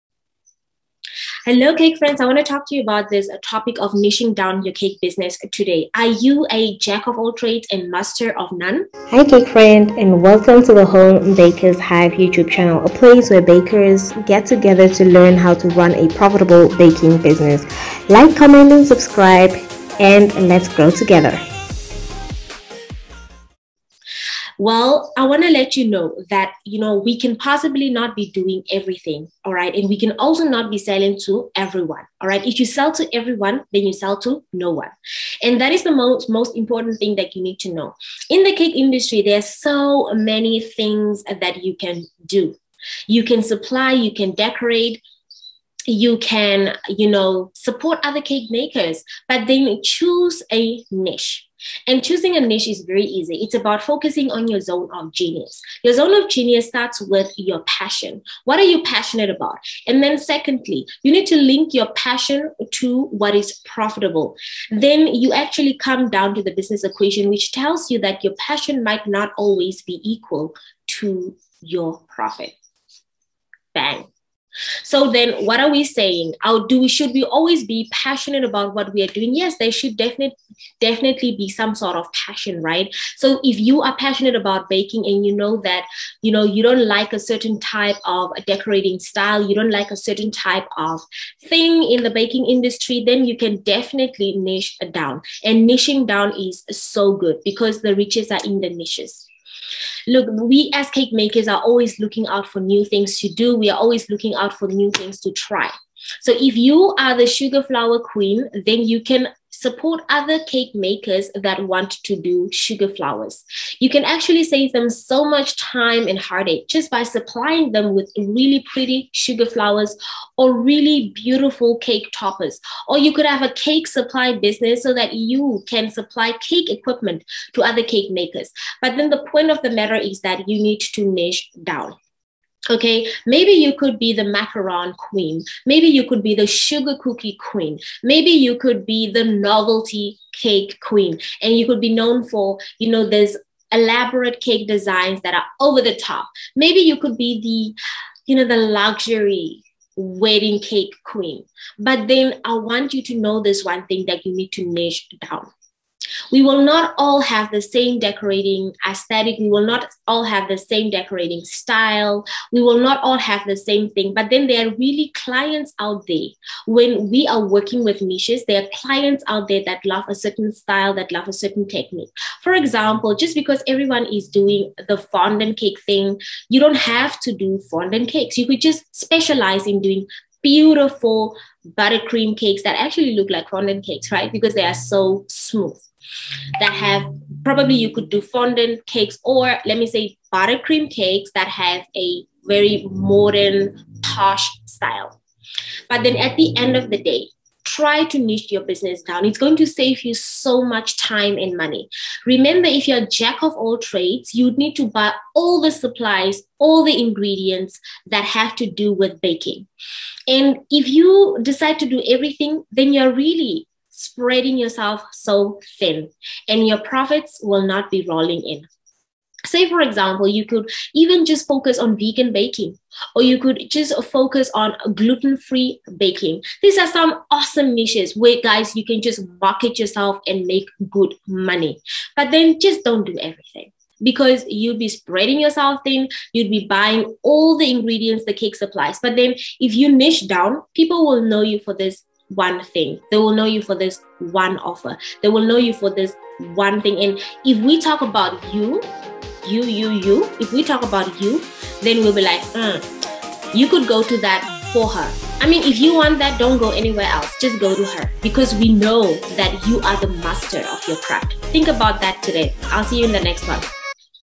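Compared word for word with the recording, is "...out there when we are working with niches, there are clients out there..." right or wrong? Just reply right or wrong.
right.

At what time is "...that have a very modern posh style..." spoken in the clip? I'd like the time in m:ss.
3:11.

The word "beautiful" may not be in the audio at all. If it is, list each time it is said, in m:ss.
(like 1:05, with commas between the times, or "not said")
2:01, 3:00.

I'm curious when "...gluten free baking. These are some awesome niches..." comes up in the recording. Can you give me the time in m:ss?
3:44.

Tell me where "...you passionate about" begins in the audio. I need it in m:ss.
0:58.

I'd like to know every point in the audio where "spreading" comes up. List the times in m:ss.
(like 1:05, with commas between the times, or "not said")
3:34, 3:54.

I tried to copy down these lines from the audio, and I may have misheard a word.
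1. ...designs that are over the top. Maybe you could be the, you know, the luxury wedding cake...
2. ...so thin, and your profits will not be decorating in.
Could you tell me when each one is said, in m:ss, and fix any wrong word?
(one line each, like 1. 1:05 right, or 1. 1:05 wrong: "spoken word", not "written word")
1. 2:24 right
2. 3:35 wrong: "rolling", not "decorating".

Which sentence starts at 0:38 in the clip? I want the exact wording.
In the cake industry, there's so many things that you can do.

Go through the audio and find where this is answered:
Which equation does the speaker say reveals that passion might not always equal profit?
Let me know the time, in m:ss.
1:06.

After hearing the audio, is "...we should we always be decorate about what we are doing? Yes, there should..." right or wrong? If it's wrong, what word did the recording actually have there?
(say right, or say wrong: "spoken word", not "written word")
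wrong: "passionate", not "decorate".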